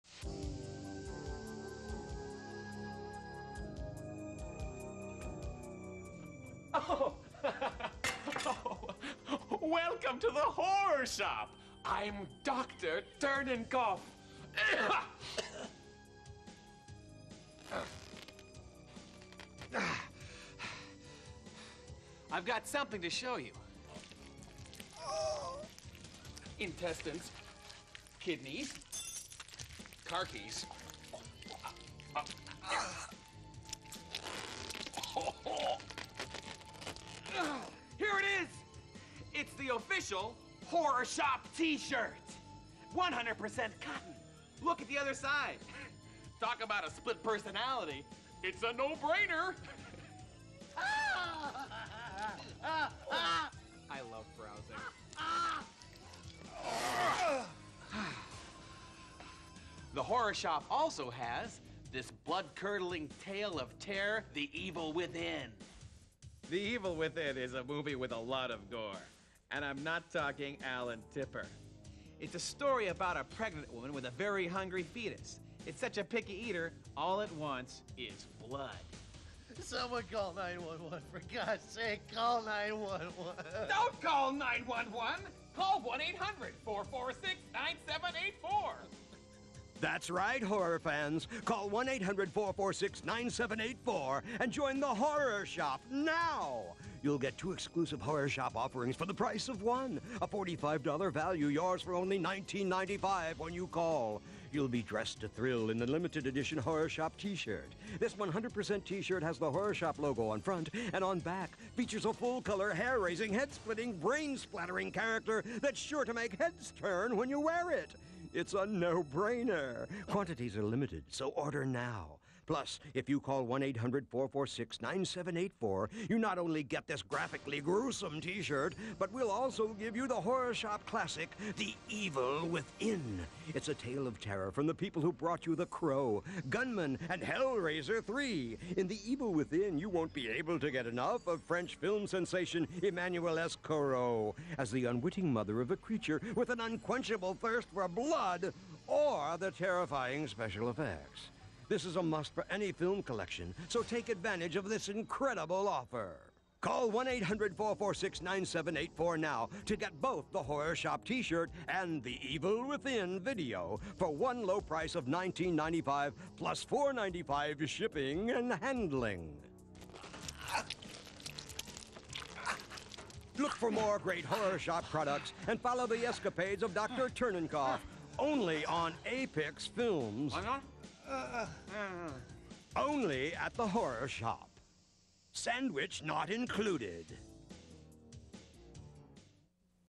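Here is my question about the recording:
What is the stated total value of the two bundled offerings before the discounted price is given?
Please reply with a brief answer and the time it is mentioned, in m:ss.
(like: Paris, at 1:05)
$45, at 1:40.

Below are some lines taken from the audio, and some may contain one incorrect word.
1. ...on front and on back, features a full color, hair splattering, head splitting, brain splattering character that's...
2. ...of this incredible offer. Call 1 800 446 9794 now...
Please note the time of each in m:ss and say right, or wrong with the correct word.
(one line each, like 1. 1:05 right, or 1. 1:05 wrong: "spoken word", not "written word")
1. 1:50 wrong: "raising", not "splattering"
2. 2:34 wrong: "9784", not "9794".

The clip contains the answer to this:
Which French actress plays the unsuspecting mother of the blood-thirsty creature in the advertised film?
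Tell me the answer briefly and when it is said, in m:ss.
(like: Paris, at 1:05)
Emmanuelle Escourrou, at 2:22.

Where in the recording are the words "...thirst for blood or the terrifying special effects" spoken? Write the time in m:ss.
2:27.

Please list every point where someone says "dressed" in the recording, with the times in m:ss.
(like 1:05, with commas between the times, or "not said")
1:44.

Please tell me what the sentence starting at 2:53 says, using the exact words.
Look for more great Horror Shop products and follow the escapades of Dr.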